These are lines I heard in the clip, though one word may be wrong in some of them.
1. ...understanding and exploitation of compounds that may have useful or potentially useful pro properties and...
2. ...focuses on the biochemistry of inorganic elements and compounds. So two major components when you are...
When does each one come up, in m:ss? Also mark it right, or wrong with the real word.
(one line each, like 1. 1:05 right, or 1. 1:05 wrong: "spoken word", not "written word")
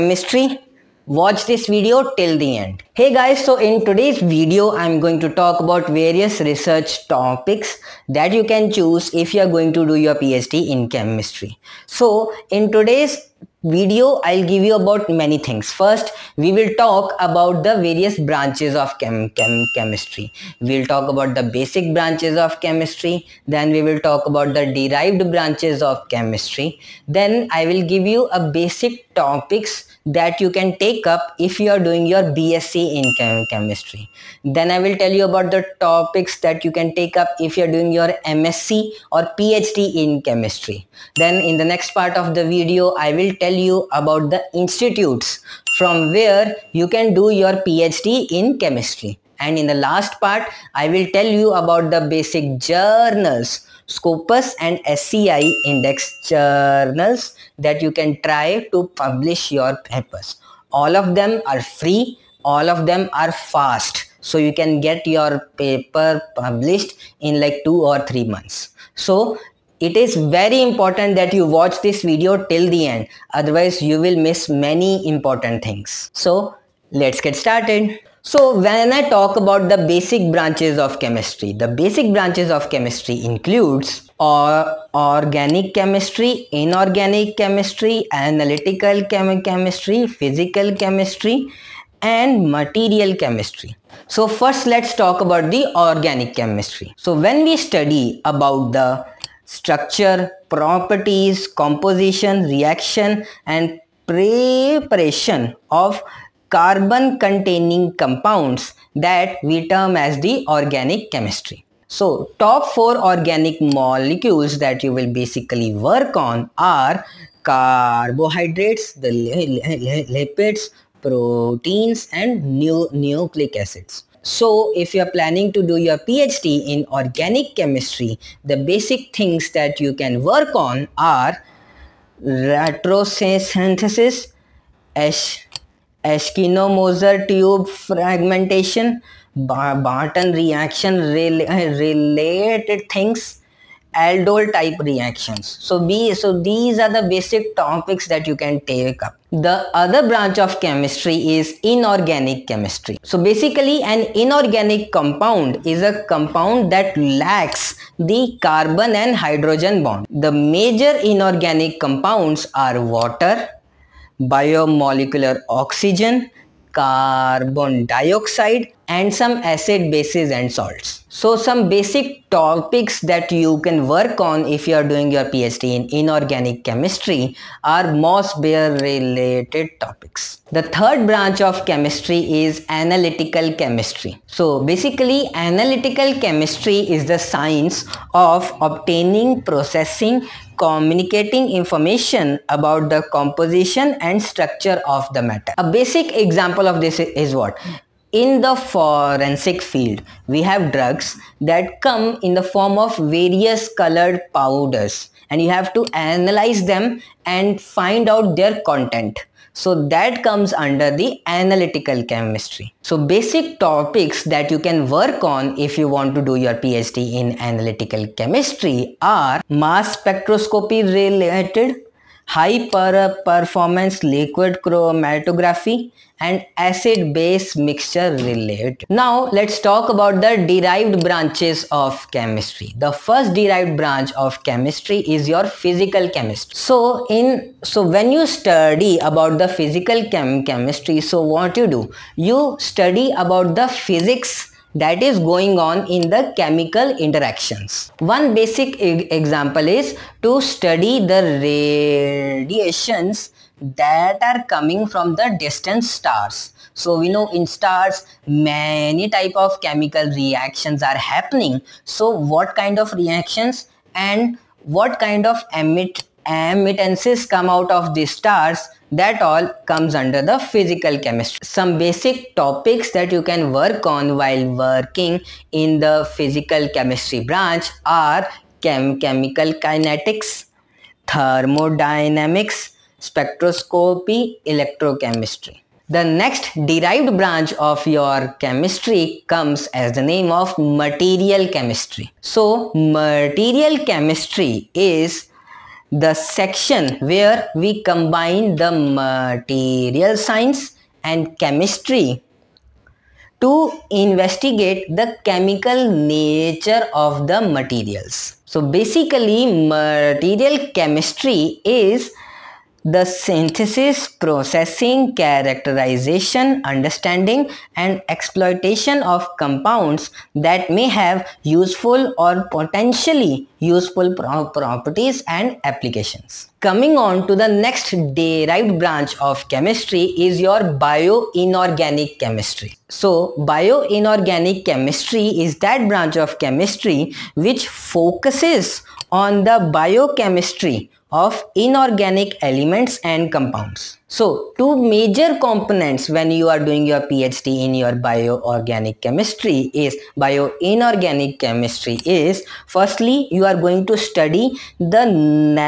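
1. 5:16 right
2. 5:37 right.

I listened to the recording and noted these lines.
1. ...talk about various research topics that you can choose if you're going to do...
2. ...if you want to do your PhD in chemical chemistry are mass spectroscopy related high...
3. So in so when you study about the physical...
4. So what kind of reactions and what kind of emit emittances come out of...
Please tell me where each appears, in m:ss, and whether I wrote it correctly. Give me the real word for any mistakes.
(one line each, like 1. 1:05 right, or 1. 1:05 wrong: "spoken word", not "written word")
1. 0:05 right
2. 3:35 wrong: "analytical", not "chemical"
3. 3:56 right
4. 4:21 right.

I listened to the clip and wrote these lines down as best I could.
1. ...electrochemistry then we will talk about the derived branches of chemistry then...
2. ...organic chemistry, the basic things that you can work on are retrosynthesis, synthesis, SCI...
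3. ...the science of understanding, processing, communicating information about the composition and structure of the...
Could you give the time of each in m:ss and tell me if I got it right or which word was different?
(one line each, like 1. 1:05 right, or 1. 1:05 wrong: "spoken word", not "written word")
1. 0:22 wrong: "chemistry", not "electrochemistry"
2. 2:06 wrong: "Eschenmoser", not "SCI"
3. 3:07 wrong: "obtaining", not "understanding".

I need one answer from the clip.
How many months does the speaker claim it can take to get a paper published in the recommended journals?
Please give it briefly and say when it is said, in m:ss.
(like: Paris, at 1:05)
2 or 3 months, at 1:07.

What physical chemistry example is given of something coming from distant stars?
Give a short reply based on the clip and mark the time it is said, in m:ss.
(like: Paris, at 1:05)
Radiations, at 4:12.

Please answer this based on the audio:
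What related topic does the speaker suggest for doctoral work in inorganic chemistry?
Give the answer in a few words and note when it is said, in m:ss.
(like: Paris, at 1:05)
Mössbauer, at 2:57.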